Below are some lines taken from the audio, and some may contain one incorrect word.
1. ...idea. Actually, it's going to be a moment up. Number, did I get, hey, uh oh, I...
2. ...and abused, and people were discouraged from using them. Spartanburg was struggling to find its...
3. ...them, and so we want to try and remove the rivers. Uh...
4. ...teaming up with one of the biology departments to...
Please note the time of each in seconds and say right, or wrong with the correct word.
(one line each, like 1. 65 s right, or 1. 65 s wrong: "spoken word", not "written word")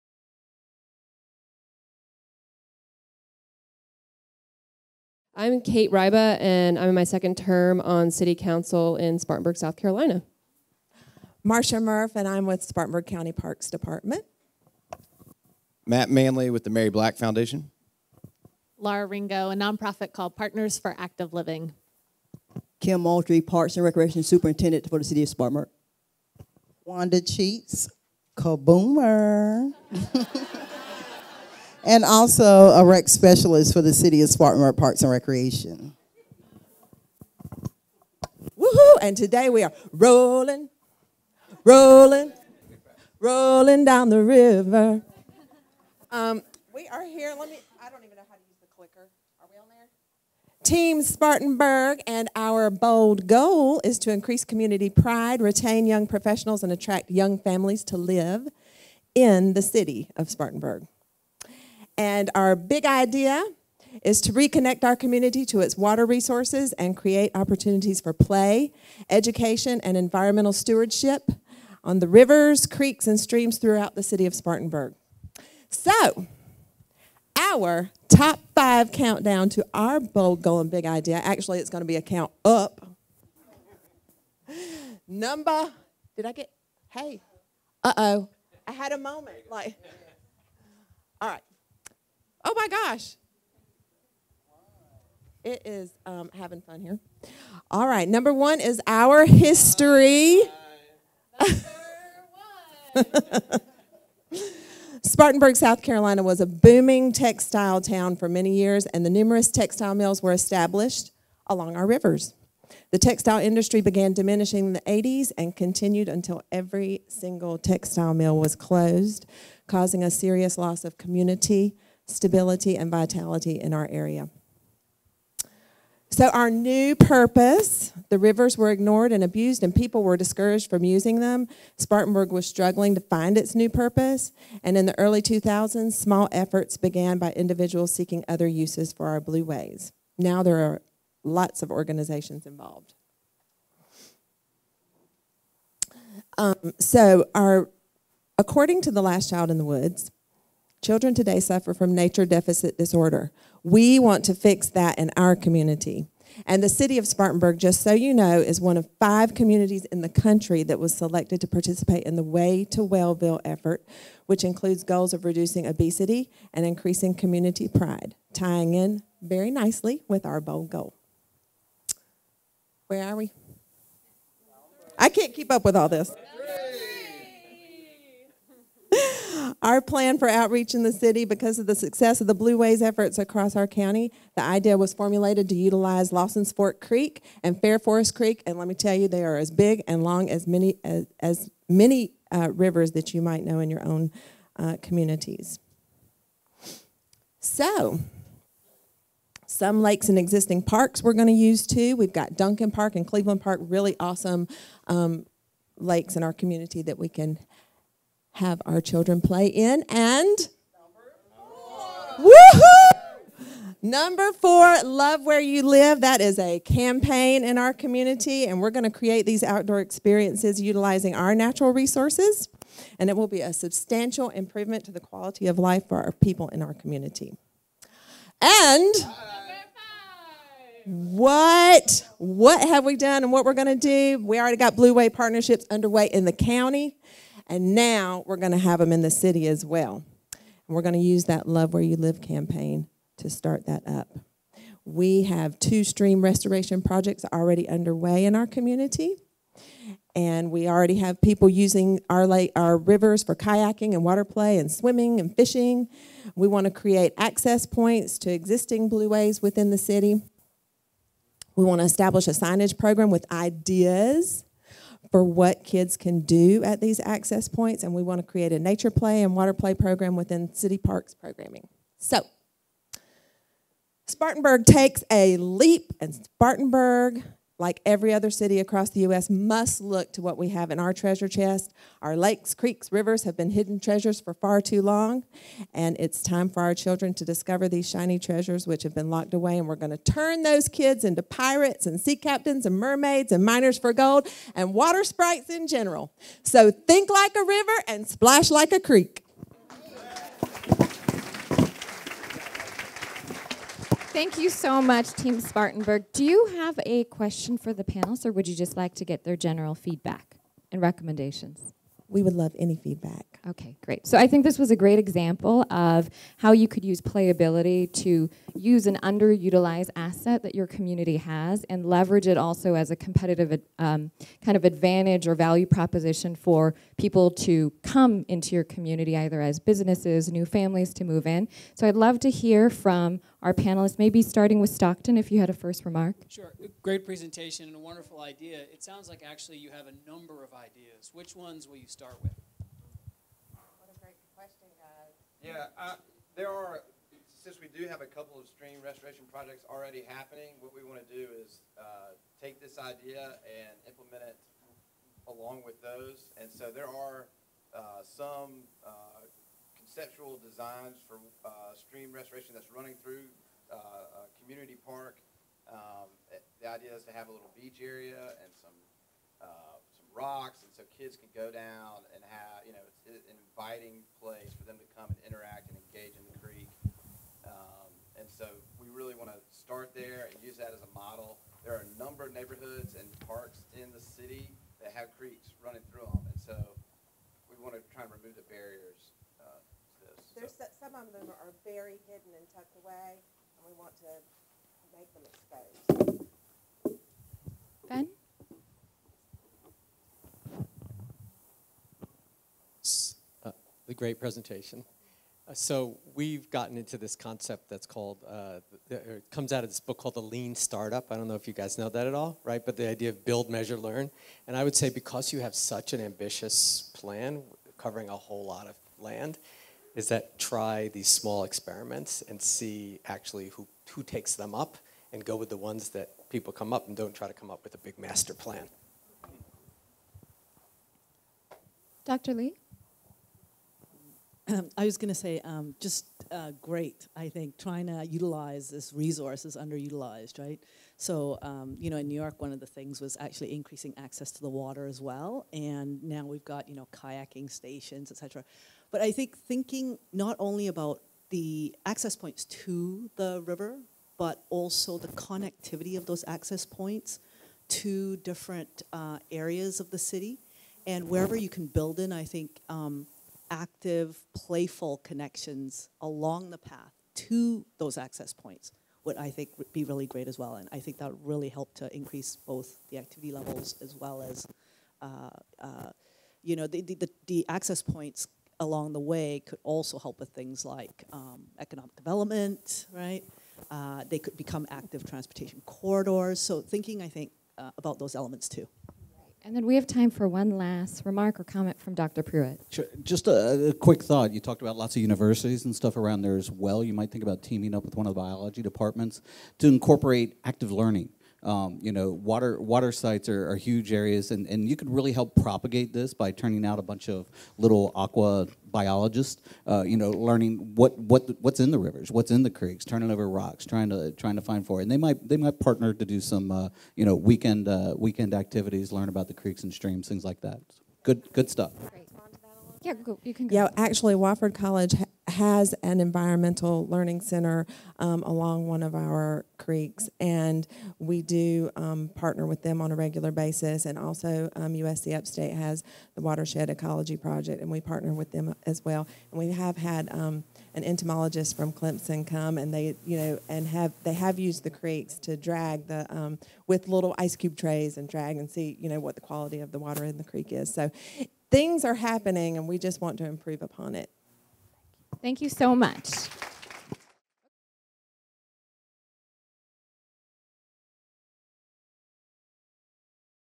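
1. 80 s wrong: "count", not "moment"
2. 129 s right
3. 386 s wrong: "barriers", not "rivers"
4. 497 s right.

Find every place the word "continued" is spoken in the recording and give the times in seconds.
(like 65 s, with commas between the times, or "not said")
115 s.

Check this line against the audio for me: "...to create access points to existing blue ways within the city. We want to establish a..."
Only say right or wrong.
right.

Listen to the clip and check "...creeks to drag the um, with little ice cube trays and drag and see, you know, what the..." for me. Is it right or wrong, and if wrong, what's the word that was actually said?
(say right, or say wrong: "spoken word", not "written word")
right.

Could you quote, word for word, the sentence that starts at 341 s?
Which ones will you start with?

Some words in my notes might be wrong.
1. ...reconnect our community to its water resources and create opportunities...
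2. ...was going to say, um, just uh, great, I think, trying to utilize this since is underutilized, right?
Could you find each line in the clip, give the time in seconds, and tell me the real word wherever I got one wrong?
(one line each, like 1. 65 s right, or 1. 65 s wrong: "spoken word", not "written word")
1. 64 s right
2. 434 s wrong: "resource", not "since".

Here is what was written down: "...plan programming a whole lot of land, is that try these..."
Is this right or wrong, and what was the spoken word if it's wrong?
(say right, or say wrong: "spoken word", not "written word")
wrong: "covering", not "programming".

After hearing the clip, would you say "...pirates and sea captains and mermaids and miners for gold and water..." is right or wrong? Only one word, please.
right.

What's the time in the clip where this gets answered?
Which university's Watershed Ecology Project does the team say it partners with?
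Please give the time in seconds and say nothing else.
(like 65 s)
534 s.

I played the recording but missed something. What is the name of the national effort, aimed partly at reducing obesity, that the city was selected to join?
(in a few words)
Way to Wellville.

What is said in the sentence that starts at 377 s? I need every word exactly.
Um, and so we really want to start there and use that as a model.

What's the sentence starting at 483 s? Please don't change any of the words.
Uh, they could become active transportation corridors.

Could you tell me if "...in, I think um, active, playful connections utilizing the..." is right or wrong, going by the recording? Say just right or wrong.
wrong.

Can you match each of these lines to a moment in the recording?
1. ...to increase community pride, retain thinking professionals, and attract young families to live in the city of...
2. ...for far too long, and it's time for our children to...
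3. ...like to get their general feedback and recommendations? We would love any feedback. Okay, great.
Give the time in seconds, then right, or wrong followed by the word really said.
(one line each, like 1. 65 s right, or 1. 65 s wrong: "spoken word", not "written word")
1. 53 s wrong: "young", not "thinking"
2. 284 s right
3. 308 s right.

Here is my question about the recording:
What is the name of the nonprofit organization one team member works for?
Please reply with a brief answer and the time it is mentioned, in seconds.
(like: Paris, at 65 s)
Partners for Active Living, at 20 s.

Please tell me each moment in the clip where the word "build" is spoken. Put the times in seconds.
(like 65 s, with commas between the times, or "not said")
413 s, 461 s.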